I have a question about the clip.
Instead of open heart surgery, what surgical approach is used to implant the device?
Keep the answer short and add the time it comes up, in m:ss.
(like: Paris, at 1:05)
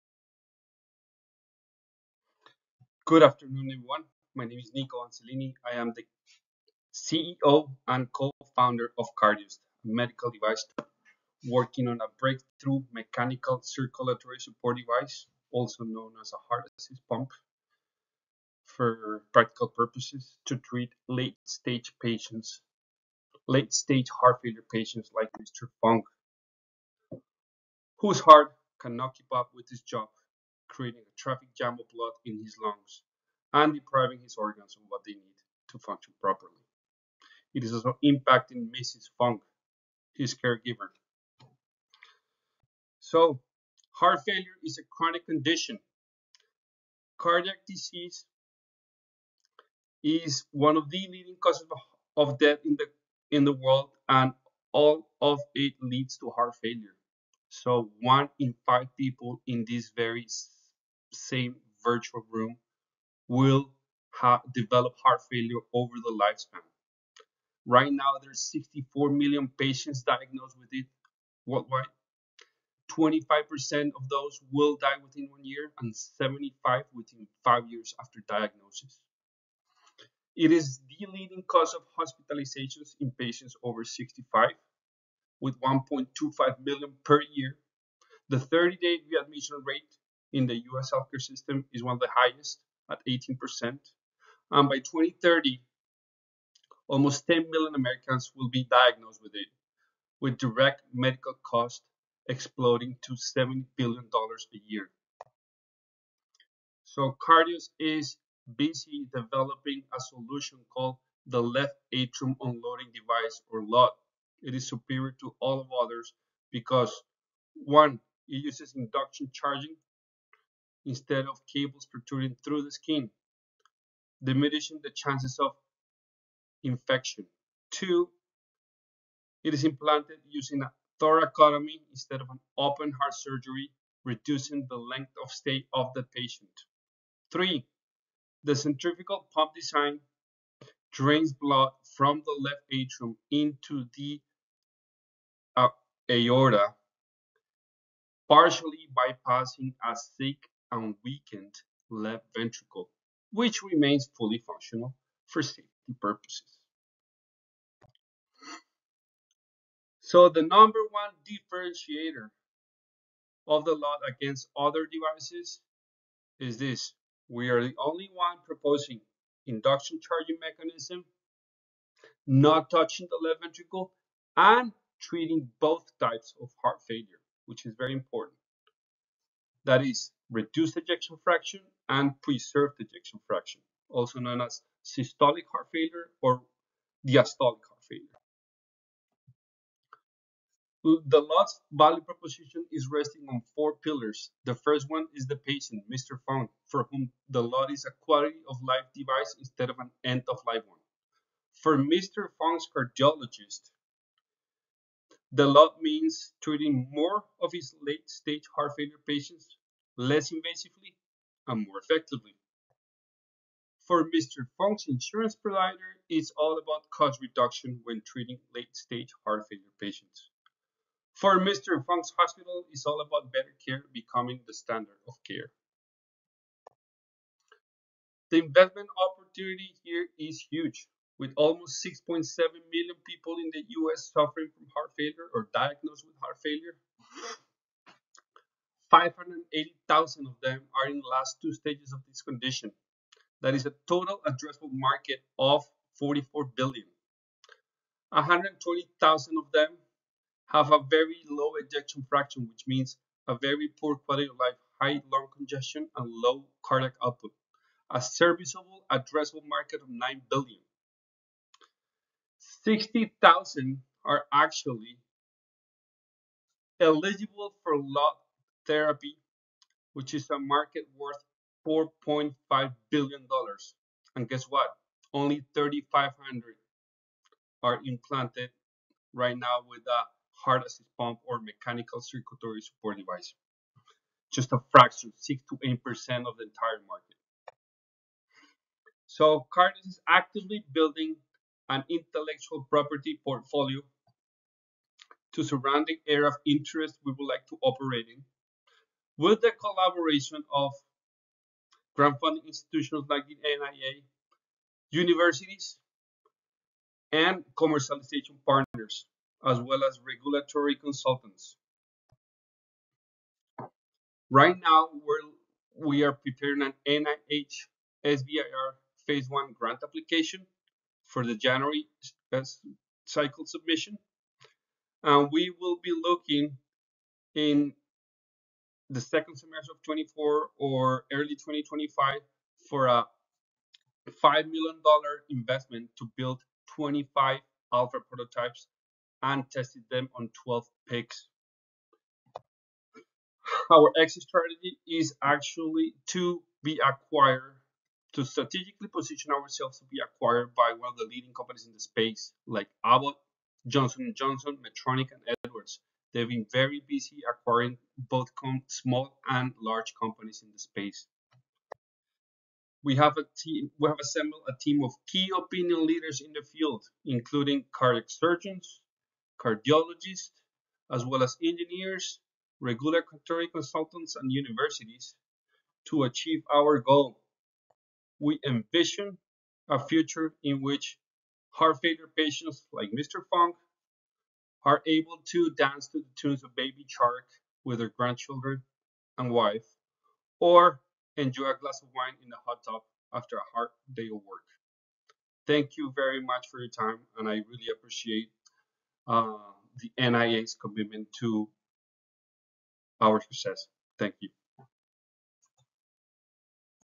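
thoracotomy, at 2:10.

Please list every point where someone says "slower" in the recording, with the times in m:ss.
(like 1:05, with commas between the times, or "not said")
not said.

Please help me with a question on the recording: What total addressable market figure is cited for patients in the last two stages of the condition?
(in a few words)
$44 billion.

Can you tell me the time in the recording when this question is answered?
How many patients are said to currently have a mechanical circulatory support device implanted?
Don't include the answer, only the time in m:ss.
4:35.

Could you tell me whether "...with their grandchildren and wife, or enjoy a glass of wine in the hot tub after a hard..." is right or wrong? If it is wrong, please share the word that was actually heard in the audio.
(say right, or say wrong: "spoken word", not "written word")
right.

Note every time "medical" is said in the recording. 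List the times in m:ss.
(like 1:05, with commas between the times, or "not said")
0:09, 1:40.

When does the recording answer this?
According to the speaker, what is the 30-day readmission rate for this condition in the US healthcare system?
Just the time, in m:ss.
1:33.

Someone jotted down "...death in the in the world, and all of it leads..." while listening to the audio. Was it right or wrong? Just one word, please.
right.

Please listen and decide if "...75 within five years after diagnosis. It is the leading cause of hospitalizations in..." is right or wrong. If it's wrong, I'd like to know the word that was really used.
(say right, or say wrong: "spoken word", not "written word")
right.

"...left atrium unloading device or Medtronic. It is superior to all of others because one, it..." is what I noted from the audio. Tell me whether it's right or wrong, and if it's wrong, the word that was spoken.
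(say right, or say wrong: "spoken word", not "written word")
wrong: "LOT", not "Medtronic".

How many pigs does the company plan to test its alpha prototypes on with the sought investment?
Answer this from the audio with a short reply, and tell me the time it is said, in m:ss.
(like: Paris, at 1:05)
12, at 5:40.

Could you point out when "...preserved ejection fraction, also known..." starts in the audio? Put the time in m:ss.
3:02.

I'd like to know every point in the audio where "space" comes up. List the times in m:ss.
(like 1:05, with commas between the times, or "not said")
5:51, 6:00.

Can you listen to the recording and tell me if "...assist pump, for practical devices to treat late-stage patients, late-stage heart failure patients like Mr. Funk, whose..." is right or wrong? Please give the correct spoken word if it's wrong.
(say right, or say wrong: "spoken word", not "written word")
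wrong: "purposes", not "devices".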